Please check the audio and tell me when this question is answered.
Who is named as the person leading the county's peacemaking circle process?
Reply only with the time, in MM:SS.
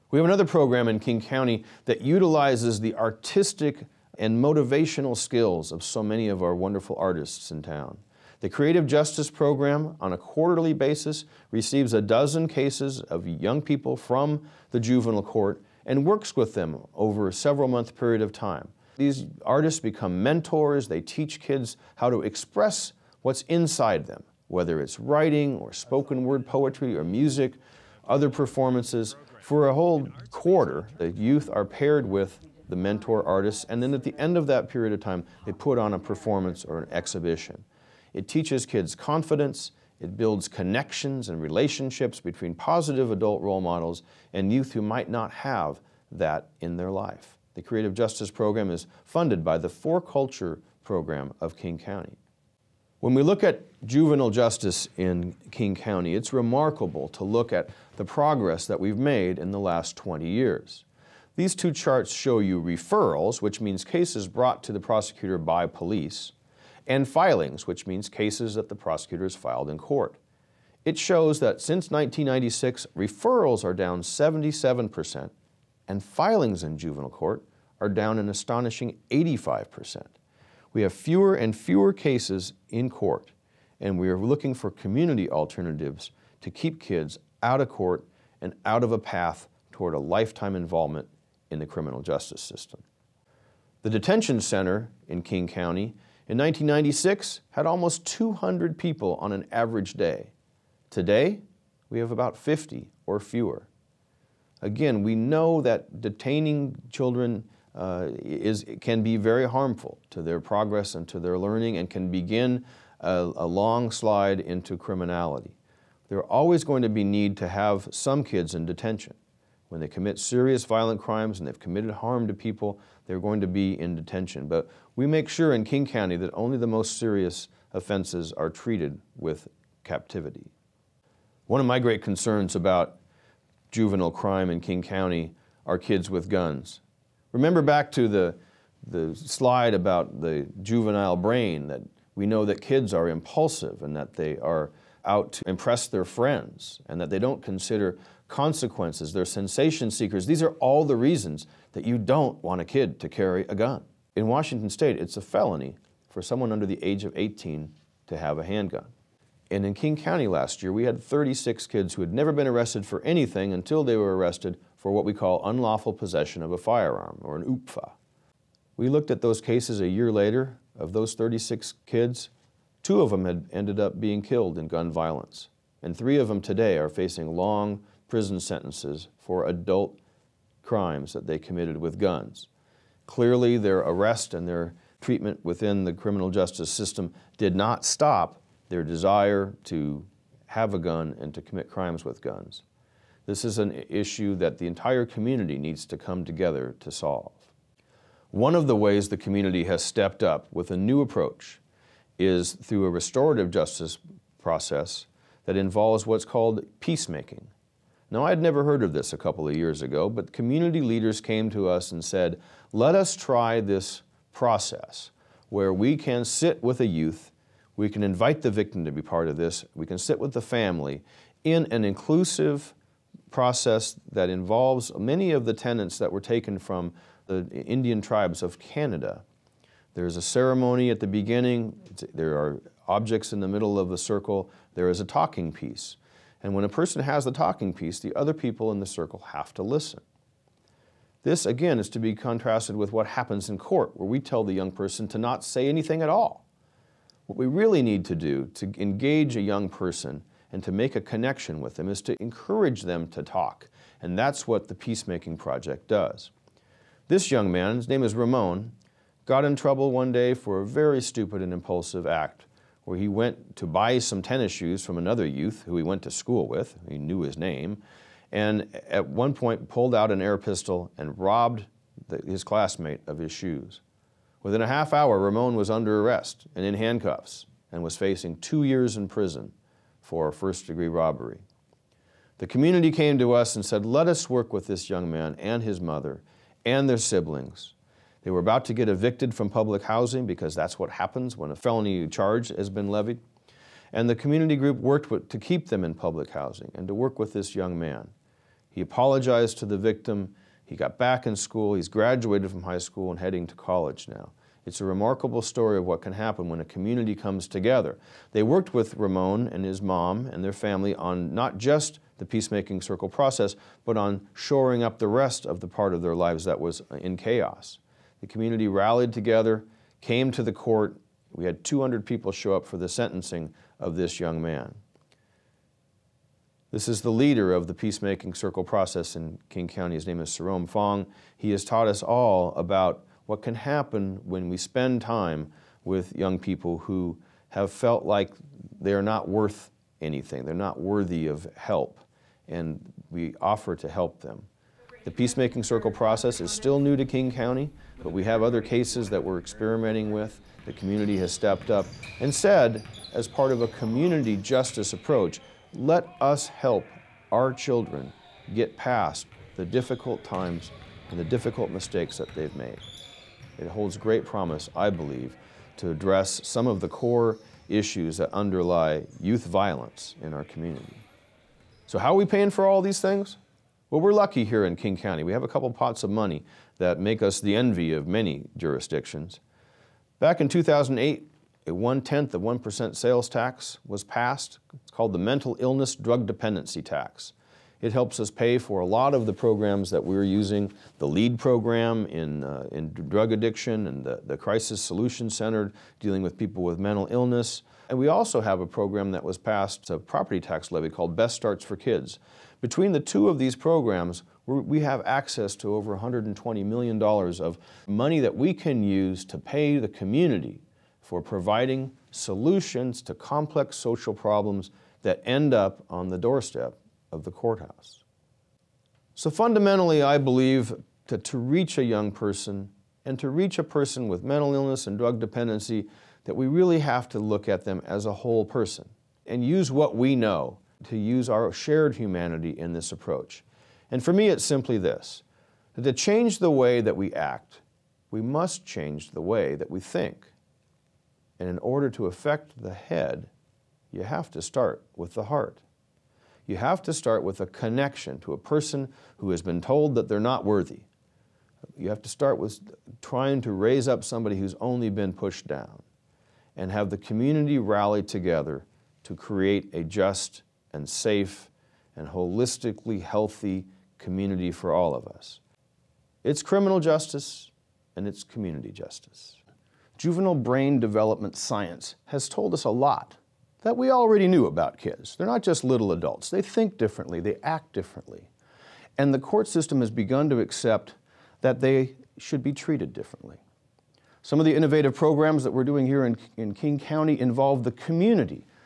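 05:30.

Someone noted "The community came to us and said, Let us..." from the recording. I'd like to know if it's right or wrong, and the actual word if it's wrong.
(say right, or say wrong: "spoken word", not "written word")
right.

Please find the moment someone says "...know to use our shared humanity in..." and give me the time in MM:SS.
07:10.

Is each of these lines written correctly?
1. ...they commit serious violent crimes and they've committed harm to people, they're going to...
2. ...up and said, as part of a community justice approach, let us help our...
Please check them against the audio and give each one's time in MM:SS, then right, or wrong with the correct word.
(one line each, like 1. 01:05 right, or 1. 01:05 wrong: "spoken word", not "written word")
1. 01:59 right
2. 05:51 right.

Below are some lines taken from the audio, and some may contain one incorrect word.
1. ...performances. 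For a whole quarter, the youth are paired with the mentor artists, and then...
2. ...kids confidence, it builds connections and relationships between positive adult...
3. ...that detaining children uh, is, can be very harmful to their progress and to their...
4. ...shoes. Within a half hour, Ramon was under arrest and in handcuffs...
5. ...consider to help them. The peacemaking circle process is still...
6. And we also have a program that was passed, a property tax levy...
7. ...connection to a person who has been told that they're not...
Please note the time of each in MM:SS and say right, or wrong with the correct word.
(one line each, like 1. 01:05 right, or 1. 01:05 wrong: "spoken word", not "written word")
1. 00:28 right
2. 00:38 right
3. 01:45 right
4. 04:33 right
5. 05:43 wrong: "offer", not "consider"
6. 06:37 right
7. 07:27 right.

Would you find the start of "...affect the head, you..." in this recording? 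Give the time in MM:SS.
07:22.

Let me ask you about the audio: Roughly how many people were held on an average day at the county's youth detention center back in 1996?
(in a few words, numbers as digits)
almost 200.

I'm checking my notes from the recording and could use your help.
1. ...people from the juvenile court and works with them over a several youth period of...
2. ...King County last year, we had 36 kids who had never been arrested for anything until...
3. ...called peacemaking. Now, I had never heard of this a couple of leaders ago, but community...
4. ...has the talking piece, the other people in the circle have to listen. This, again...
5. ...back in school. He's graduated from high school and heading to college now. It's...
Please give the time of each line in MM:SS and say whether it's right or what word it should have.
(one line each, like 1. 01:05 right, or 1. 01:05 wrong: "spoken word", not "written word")
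1. 00:13 wrong: "month", not "youth"
2. 02:39 right
3. 03:26 wrong: "years", not "leaders"
4. 03:57 right
5. 05:00 right.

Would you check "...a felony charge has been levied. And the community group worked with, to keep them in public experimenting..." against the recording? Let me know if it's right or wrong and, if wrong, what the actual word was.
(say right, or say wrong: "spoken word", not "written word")
wrong: "housing", not "experimenting".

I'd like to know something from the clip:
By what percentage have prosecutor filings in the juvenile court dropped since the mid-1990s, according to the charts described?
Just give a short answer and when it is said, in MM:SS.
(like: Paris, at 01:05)
85%, at 01:19.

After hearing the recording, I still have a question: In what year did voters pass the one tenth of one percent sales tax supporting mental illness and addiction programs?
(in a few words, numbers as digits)
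2008.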